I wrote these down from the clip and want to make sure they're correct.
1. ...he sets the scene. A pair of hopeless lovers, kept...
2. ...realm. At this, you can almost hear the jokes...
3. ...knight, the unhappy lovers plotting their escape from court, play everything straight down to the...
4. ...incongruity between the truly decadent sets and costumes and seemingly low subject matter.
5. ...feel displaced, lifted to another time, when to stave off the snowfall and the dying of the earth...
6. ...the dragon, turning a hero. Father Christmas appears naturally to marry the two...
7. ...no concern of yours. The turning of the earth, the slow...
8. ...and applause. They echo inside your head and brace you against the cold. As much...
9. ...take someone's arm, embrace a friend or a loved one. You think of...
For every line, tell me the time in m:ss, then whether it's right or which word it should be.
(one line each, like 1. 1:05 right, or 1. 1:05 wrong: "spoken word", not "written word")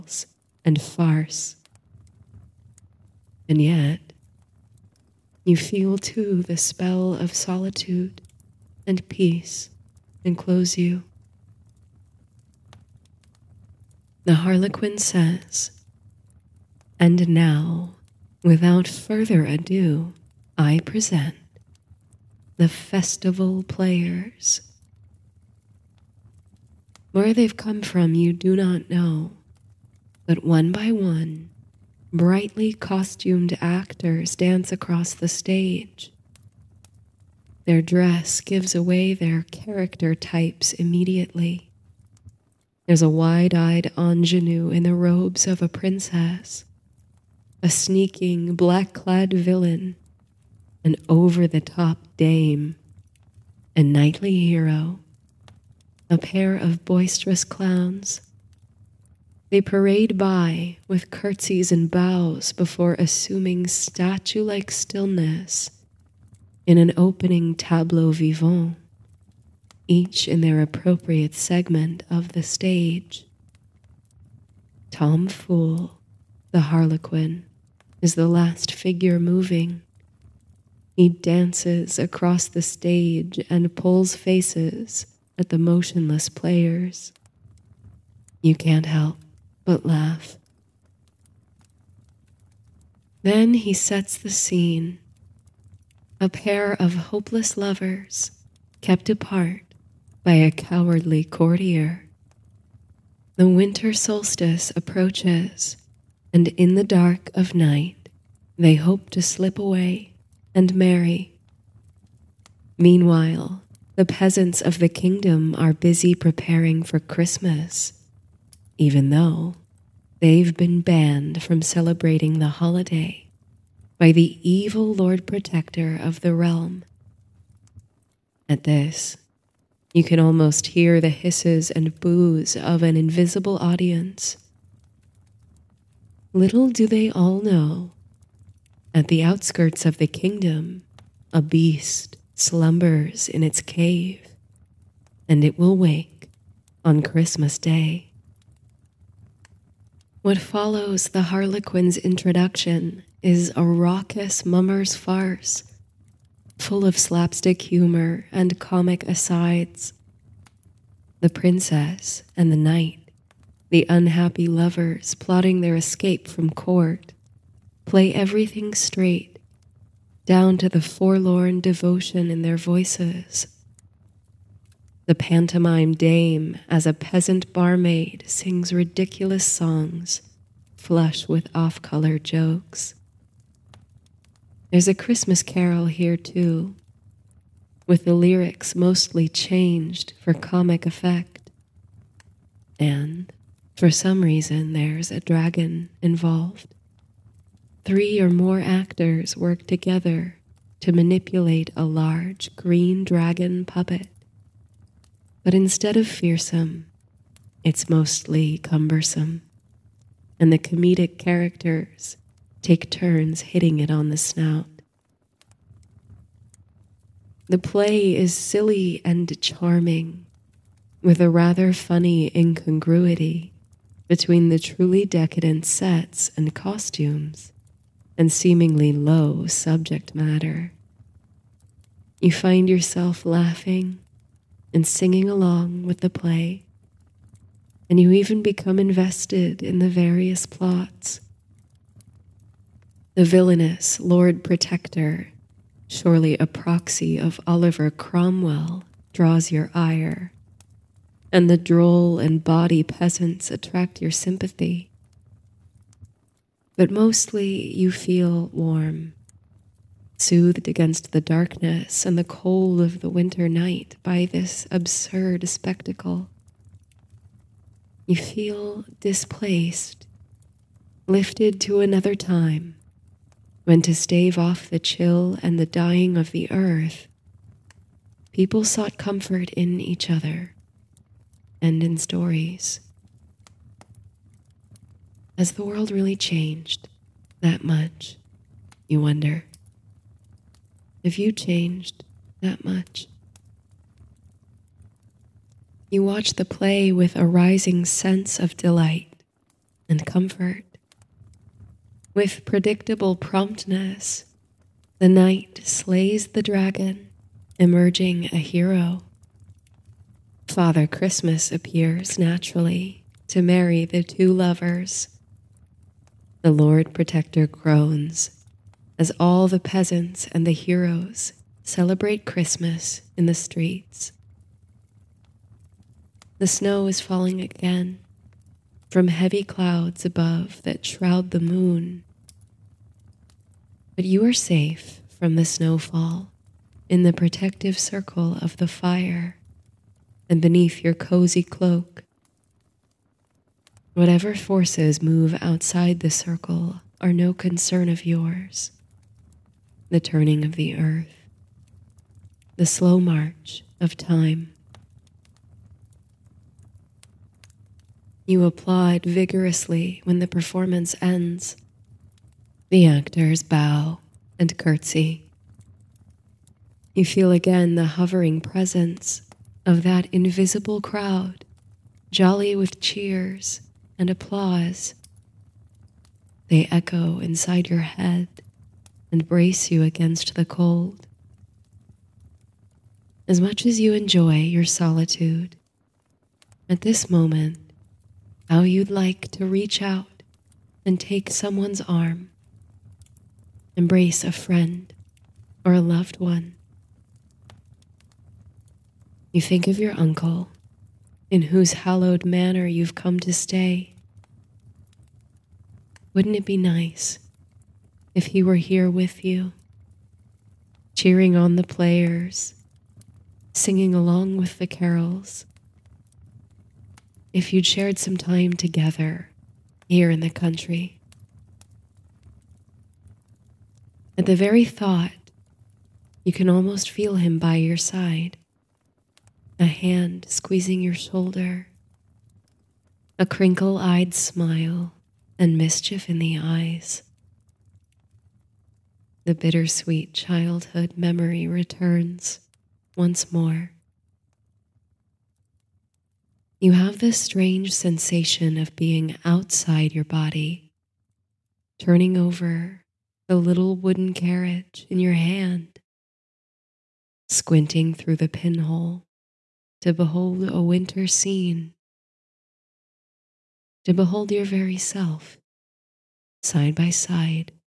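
1. 1:33 right
2. 2:06 wrong: "hisses", not "jokes"
3. 2:42 right
4. 3:42 right
5. 4:28 wrong: "chill", not "snowfall"
6. 5:06 wrong: "emerging", not "turning"
7. 5:47 right
8. 6:13 right
9. 6:30 right.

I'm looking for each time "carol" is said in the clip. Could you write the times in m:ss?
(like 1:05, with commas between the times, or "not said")
3:05, 6:54.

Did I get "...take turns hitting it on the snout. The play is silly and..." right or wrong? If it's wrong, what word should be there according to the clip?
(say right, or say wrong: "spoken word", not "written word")
right.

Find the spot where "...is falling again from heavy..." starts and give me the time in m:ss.
5:26.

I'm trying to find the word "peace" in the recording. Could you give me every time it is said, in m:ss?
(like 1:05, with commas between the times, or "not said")
0:09.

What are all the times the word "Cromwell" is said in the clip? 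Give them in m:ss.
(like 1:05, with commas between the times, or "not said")
4:07.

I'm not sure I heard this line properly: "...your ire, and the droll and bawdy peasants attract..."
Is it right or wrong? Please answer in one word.
right.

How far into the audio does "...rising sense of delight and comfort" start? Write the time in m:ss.
4:57.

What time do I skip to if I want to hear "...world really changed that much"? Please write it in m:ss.
4:45.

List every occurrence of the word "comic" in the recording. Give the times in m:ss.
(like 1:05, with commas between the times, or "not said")
2:38, 3:10.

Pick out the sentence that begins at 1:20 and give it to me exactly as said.
He dances across the stage and pulls faces at the motionless players.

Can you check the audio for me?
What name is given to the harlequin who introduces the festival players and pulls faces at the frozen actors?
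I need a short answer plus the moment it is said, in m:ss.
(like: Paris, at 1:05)
Tom Fool, at 1:14.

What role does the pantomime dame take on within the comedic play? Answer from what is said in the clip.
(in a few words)
Peasant barmaid.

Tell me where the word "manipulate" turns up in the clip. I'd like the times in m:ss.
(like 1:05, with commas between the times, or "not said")
3:20.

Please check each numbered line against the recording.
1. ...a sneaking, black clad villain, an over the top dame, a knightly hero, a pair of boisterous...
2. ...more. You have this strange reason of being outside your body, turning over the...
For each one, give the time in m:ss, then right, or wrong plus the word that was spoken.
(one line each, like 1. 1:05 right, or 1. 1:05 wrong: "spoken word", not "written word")
1. 0:47 right
2. 7:23 wrong: "sensation", not "reason".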